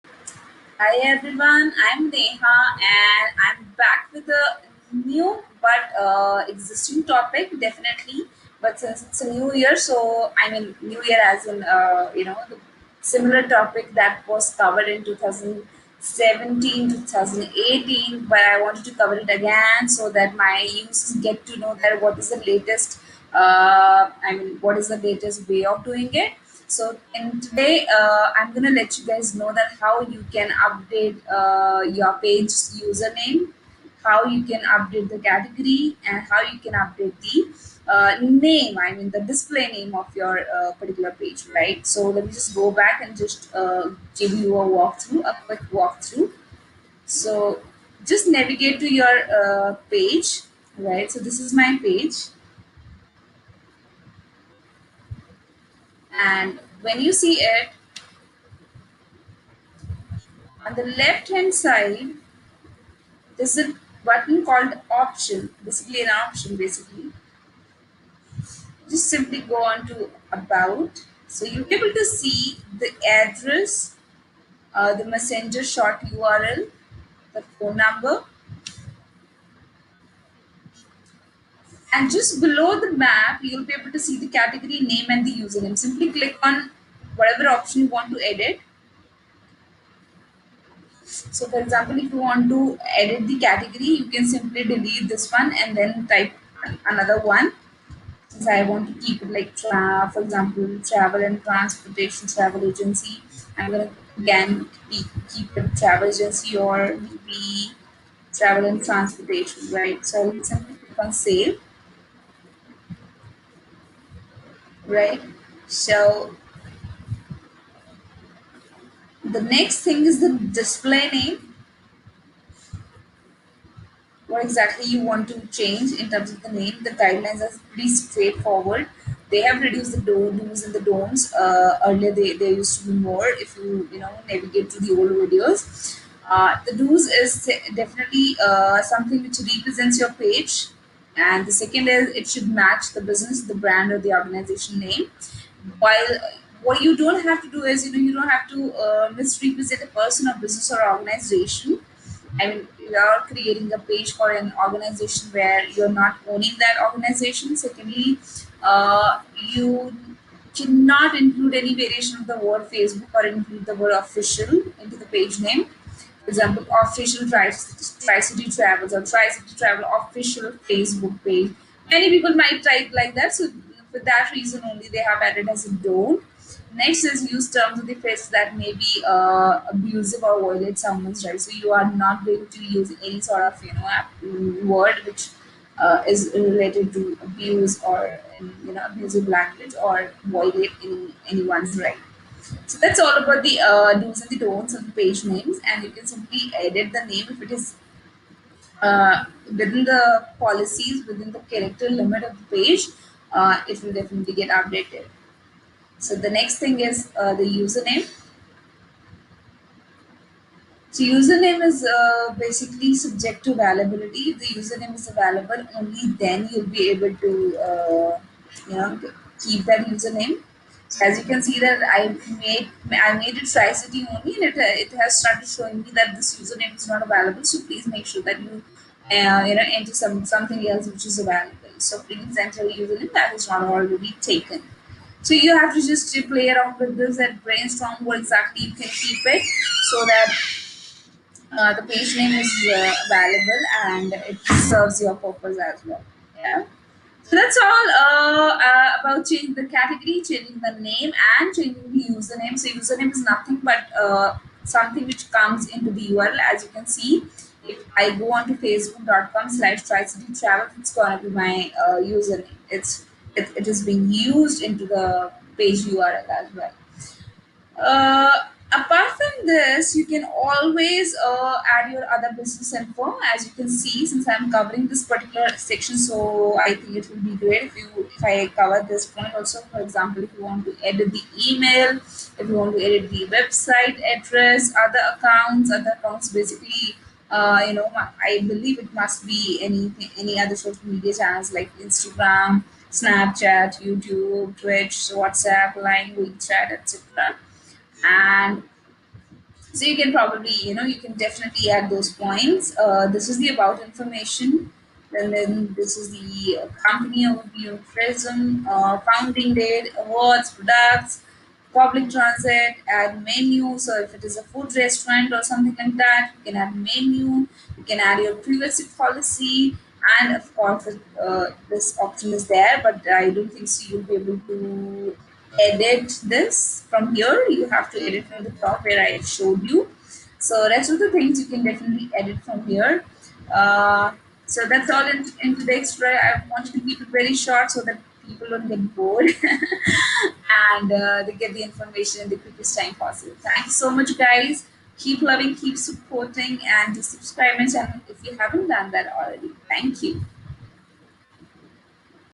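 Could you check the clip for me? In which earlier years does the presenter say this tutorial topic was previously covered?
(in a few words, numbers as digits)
2017, 2018.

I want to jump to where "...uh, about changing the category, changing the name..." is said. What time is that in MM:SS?
04:08.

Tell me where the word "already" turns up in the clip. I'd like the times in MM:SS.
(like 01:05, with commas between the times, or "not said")
03:53, 05:49.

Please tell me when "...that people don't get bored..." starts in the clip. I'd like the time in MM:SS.
05:37.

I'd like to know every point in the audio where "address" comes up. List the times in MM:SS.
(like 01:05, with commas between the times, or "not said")
01:13, 04:44.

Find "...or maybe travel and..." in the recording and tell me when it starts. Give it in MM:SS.
01:46.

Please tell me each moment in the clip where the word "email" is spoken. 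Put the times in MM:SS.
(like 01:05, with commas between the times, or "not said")
04:41.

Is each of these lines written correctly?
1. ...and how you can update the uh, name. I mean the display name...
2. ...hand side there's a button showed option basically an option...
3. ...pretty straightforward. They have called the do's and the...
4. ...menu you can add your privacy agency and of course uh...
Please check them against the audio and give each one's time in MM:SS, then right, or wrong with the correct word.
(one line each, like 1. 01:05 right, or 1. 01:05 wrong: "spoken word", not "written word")
1. 00:36 right
2. 01:01 wrong: "called", not "showed"
3. 02:07 wrong: "reduced", not "called"
4. 05:16 wrong: "policy", not "agency".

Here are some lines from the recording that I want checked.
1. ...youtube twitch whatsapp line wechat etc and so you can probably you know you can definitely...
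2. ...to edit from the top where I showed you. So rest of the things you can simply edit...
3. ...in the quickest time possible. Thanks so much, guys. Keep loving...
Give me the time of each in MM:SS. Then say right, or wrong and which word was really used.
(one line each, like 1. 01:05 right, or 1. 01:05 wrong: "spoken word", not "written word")
1. 04:53 right
2. 05:27 wrong: "definitely", not "simply"
3. 05:42 right.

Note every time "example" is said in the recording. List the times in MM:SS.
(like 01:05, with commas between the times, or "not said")
01:31, 01:40, 02:46, 04:39.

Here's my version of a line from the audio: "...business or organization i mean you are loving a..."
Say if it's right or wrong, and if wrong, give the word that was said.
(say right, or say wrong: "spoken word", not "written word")
wrong: "creating", not "loving".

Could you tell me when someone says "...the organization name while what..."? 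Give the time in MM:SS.
02:23.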